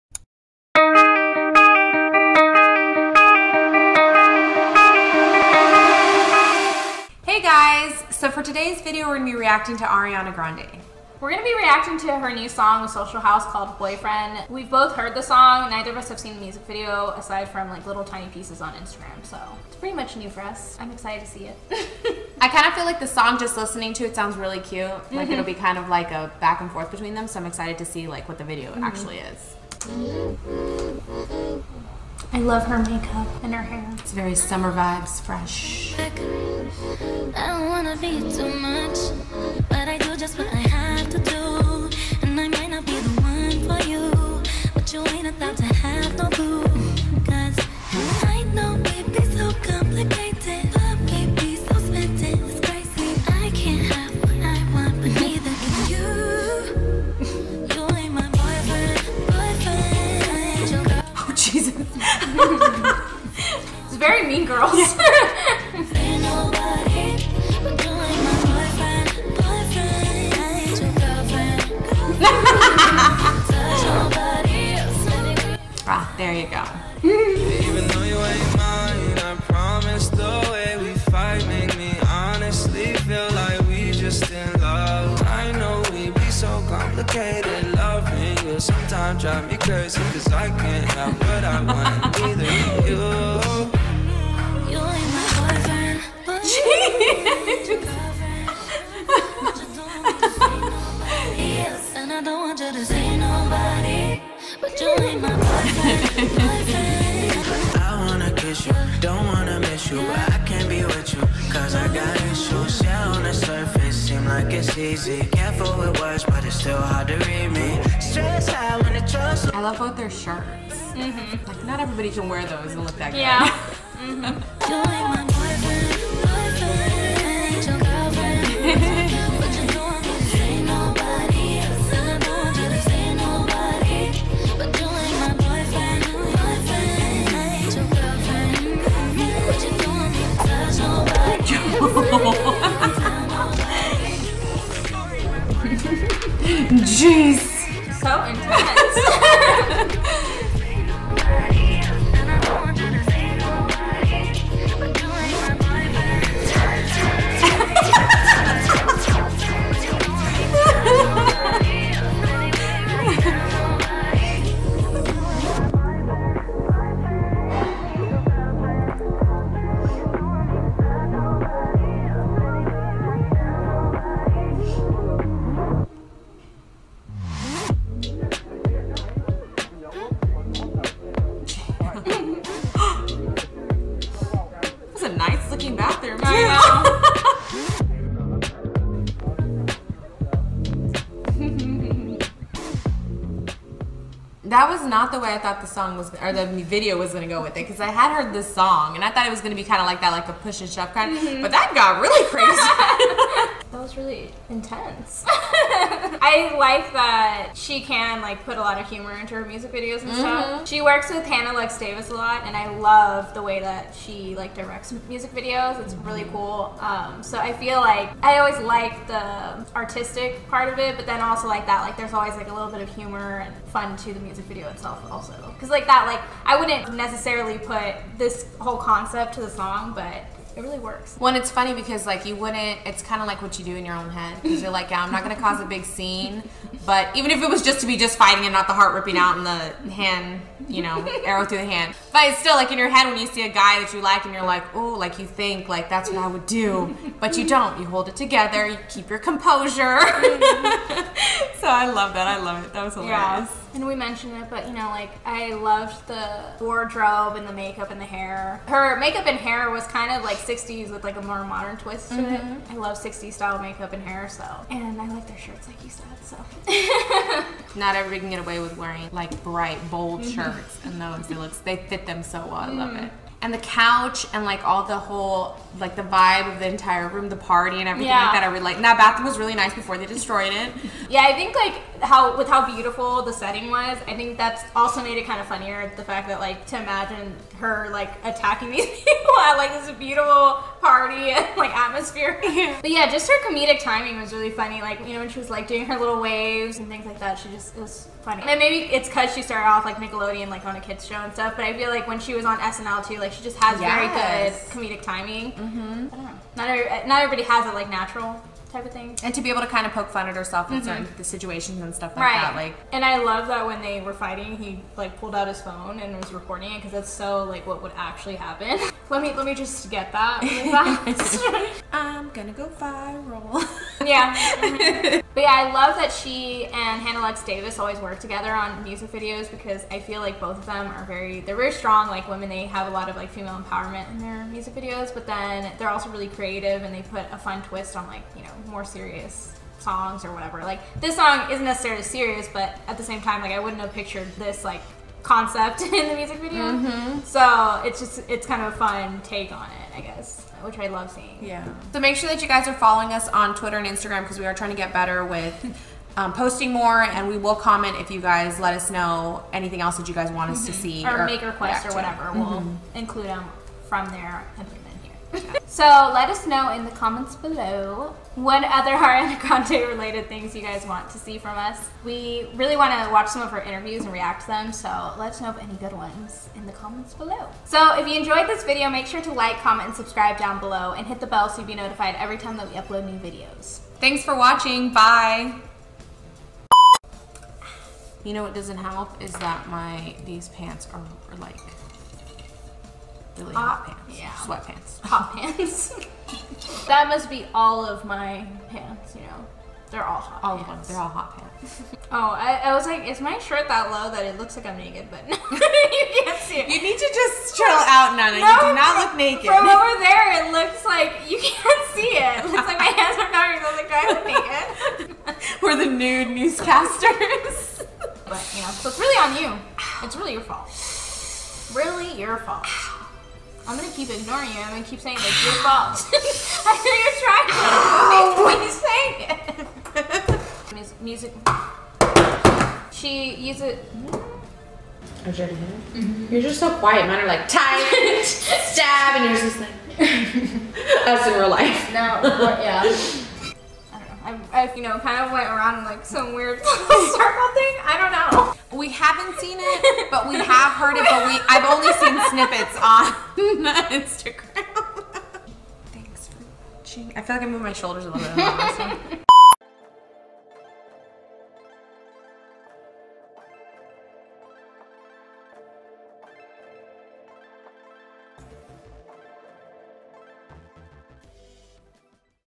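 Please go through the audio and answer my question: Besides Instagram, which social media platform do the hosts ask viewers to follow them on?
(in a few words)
Twitter.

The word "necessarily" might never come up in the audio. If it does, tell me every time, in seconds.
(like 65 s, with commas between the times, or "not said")
226 s, 341 s.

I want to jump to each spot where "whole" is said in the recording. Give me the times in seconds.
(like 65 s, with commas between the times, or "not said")
228 s, 274 s.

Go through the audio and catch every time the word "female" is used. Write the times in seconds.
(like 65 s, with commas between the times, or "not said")
333 s.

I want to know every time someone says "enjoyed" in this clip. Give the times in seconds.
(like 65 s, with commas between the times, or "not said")
378 s.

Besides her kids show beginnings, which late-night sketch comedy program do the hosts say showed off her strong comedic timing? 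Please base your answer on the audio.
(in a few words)
SNL.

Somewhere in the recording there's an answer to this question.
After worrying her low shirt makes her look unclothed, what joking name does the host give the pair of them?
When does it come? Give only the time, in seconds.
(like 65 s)
415 s.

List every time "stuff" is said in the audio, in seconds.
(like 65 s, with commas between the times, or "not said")
210 s, 301 s, 311 s.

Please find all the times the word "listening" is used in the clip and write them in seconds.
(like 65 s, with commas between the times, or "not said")
23 s.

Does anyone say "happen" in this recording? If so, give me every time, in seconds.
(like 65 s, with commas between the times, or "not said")
318 s.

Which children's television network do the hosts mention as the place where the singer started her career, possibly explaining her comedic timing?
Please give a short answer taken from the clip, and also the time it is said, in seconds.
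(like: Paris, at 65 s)
Nickelodeon, at 299 s.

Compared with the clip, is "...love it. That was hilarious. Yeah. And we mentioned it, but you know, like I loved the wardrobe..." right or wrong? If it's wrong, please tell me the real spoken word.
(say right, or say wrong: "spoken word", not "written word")
right.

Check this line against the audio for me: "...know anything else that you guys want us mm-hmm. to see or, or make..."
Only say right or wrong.
right.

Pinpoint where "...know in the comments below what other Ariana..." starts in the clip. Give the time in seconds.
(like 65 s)
366 s.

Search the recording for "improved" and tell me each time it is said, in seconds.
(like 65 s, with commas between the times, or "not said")
not said.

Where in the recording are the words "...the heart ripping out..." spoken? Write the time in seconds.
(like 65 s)
238 s.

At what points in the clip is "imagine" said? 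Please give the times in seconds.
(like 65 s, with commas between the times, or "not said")
286 s.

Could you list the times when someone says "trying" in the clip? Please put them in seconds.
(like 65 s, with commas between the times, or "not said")
354 s, 429 s.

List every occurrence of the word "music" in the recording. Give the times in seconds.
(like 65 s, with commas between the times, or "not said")
16 s, 209 s, 215 s, 224 s, 328 s, 334 s, 346 s, 431 s.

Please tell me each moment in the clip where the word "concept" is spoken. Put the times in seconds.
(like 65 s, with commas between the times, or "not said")
228 s, 345 s.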